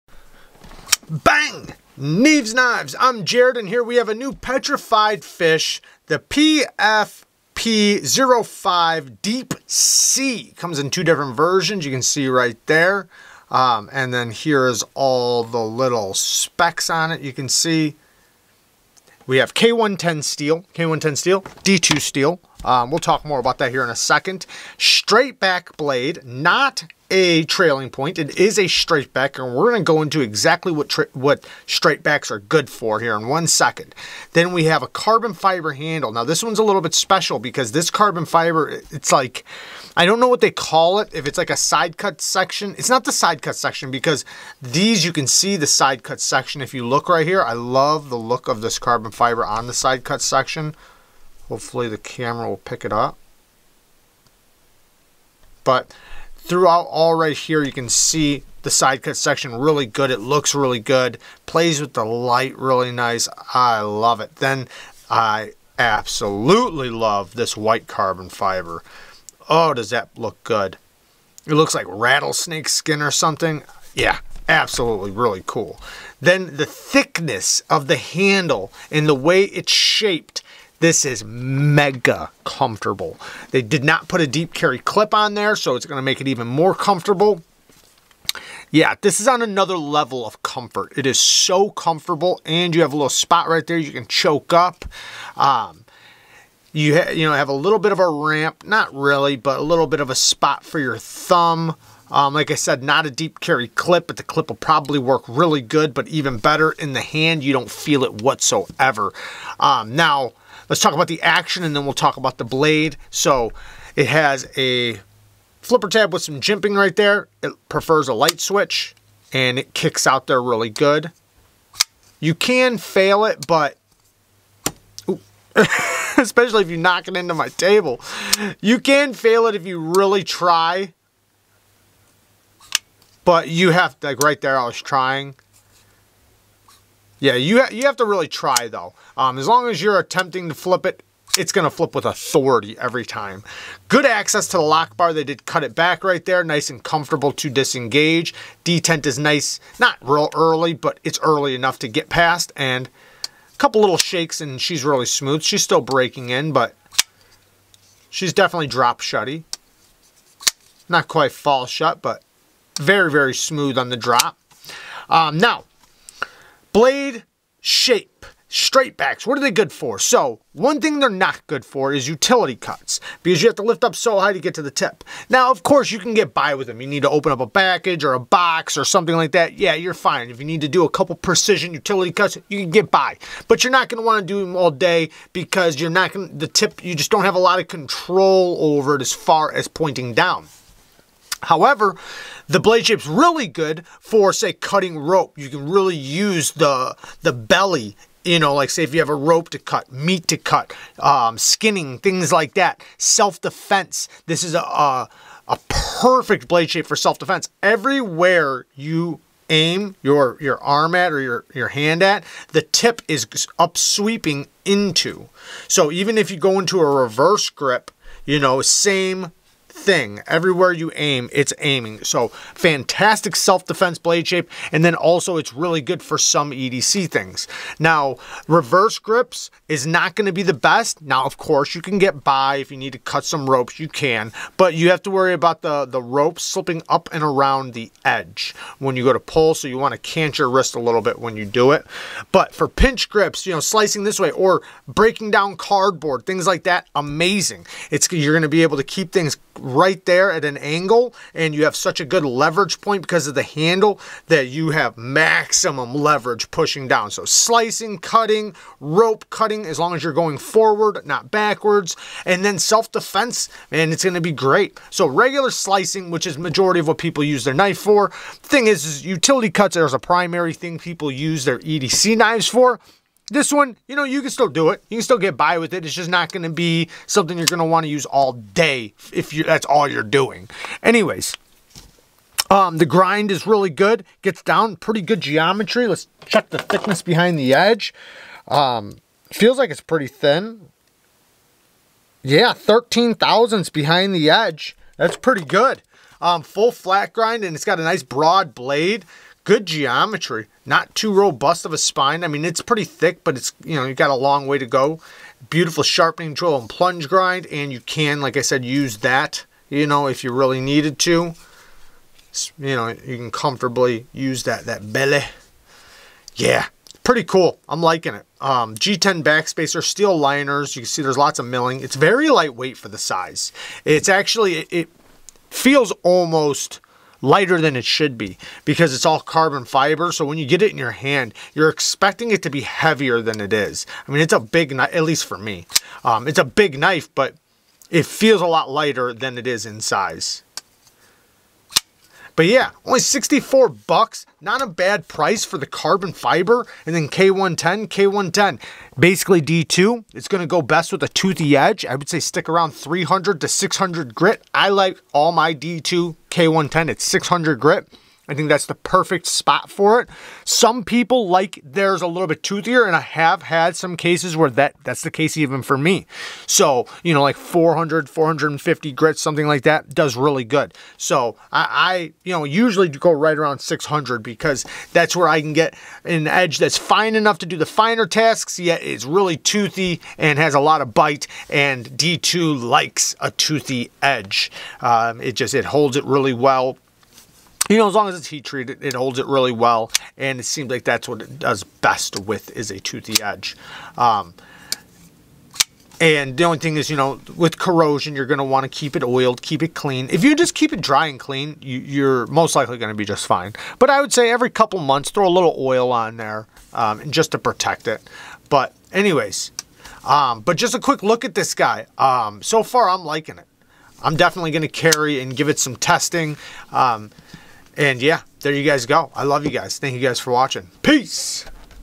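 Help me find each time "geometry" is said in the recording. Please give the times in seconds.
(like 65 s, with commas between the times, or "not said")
285 s, 299 s.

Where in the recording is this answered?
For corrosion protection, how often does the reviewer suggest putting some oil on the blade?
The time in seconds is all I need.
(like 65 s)
404 s.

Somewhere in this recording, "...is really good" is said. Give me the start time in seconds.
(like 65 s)
283 s.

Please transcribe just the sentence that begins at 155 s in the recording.
She's still breaking in, but she's definitely drop shutty.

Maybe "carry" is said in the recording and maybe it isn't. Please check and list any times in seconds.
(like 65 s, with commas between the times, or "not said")
84 s, 103 s, 414 s.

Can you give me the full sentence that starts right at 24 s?
Straight back blade, not a trailing point.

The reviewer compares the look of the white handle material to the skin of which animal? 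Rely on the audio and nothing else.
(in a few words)
Rattlesnake.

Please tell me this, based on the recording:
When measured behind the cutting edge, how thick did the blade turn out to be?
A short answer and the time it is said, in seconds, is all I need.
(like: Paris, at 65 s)
13 thousandths, at 292 s.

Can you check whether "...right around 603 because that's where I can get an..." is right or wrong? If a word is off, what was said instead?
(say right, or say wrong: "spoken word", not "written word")
wrong: "600", not "603".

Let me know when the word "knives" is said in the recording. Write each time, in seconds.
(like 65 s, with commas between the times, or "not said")
2 s, 272 s.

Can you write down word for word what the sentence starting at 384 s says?
Um, it just, it holds it really well you know, as long as it's heat treated, it holds it really well.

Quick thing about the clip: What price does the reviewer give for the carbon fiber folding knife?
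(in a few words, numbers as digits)
$64.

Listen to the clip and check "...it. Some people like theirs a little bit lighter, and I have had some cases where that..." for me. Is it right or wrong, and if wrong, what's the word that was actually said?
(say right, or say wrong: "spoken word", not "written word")
wrong: "toothier", not "lighter".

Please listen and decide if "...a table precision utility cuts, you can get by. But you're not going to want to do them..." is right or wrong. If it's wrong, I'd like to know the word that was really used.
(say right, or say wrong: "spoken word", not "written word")
wrong: "couple", not "table".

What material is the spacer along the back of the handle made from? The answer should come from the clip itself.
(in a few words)
G10.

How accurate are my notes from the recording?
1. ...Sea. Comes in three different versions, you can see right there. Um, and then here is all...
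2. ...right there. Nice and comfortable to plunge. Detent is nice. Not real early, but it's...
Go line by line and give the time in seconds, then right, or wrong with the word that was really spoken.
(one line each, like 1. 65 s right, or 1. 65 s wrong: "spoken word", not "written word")
1. 9 s wrong: "two", not "three"
2. 146 s wrong: "disengage", not "plunge".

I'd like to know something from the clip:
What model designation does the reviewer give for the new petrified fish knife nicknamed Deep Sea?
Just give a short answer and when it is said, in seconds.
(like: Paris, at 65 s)
PFP05, at 6 s.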